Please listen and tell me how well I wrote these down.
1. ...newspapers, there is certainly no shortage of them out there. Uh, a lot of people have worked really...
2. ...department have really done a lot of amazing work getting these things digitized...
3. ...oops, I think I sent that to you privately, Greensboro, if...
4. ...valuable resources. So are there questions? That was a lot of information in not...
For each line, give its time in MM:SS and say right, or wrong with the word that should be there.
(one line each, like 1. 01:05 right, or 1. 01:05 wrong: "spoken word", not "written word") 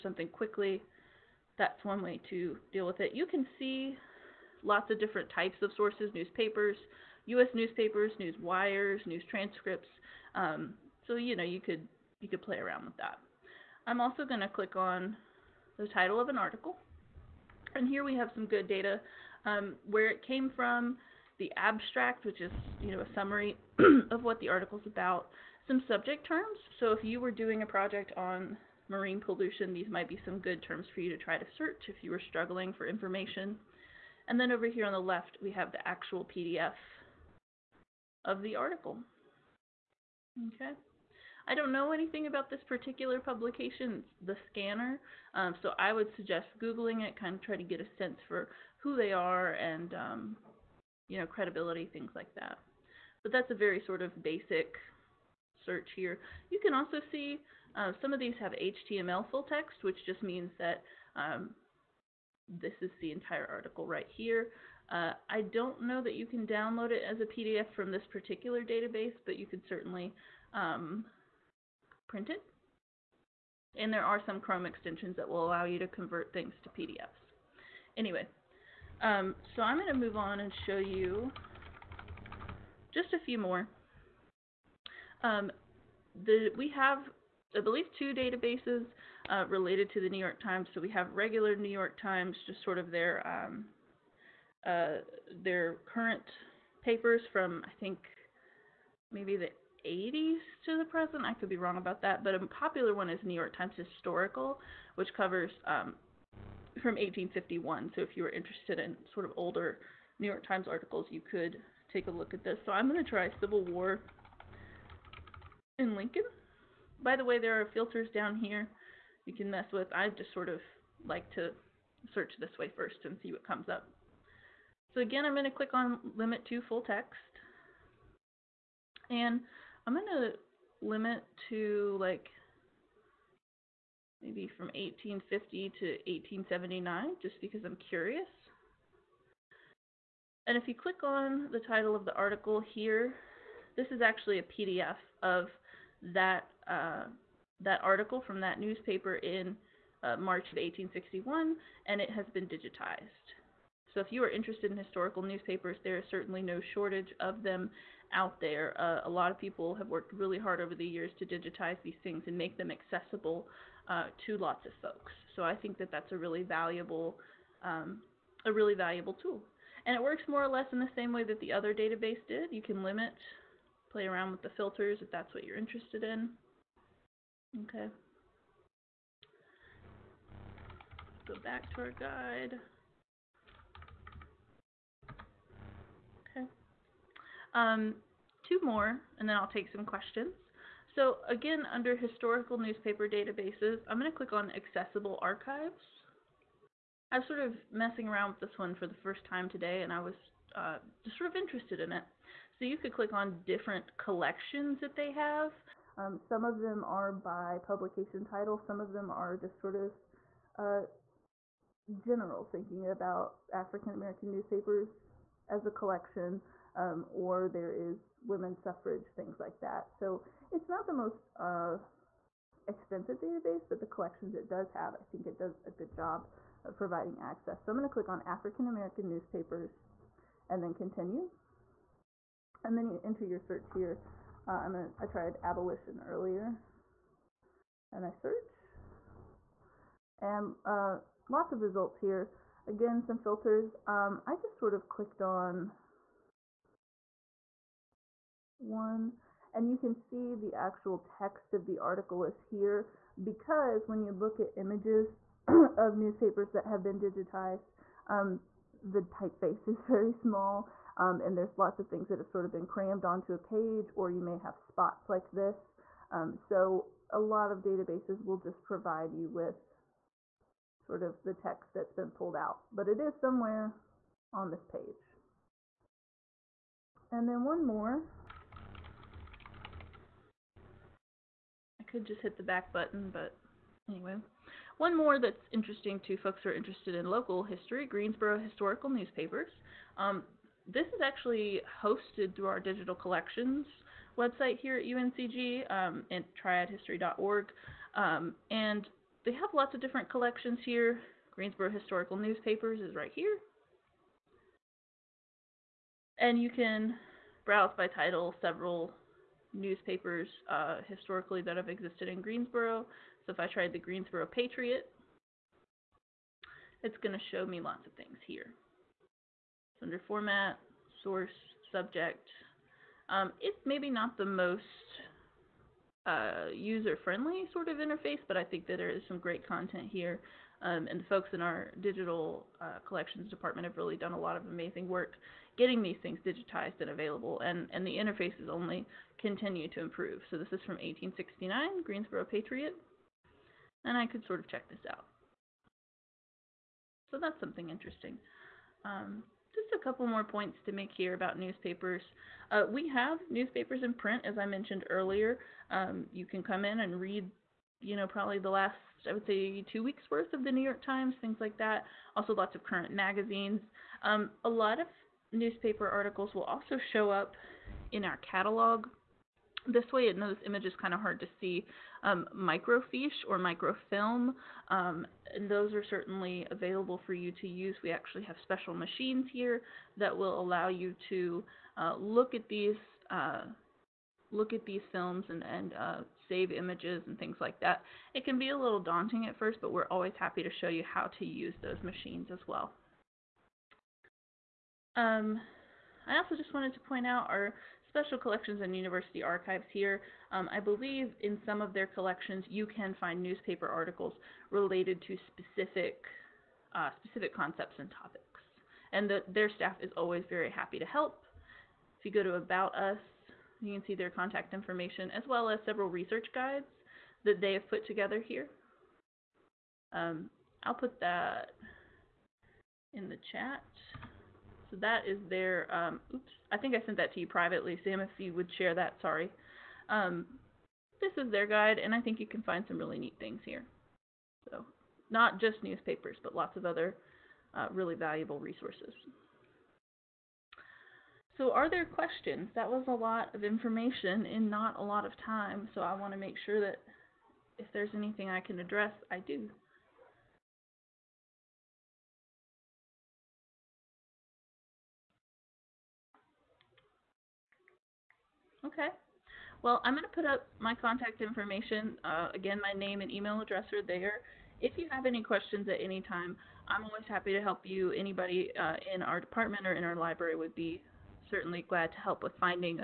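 1. 02:35 right
2. 05:33 right
3. 07:06 wrong: "Sam", not "Greensboro"
4. 07:17 right.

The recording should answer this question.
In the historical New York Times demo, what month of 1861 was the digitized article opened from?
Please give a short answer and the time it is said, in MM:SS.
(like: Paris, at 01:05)
March, at 02:30.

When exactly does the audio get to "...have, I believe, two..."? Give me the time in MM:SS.
01:26.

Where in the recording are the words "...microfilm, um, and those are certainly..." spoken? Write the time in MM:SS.
06:13.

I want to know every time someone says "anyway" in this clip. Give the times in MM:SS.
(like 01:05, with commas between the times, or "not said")
01:17, 04:43.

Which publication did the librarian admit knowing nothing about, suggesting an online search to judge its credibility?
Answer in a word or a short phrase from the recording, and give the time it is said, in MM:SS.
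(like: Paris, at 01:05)
The Scanner, at 00:44.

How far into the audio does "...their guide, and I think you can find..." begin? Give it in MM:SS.
07:11.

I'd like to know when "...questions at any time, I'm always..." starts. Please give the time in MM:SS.
07:45.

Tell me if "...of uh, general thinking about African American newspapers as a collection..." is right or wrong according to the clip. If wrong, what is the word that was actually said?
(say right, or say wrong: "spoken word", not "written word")
right.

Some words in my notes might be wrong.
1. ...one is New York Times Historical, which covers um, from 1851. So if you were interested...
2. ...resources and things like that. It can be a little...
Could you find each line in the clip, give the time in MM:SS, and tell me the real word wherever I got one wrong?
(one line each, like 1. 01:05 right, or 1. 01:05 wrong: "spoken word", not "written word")
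1. 01:42 right
2. 06:26 wrong: "images", not "resources".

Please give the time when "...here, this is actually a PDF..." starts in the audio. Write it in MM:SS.
02:22.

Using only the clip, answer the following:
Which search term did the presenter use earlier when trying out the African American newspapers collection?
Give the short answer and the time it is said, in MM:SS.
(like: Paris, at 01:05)
abolition, at 03:55.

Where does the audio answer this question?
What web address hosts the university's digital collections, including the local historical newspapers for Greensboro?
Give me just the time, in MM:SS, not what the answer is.
04:56.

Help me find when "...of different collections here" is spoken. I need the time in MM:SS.
04:59.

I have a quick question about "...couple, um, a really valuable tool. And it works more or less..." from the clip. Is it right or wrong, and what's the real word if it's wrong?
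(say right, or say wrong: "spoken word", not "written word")
wrong: "valuable", not "couple".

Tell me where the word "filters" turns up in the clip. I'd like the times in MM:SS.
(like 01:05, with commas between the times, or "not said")
01:57, 02:54, 04:03.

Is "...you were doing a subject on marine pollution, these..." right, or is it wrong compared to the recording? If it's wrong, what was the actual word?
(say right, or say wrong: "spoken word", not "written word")
wrong: "project", not "subject".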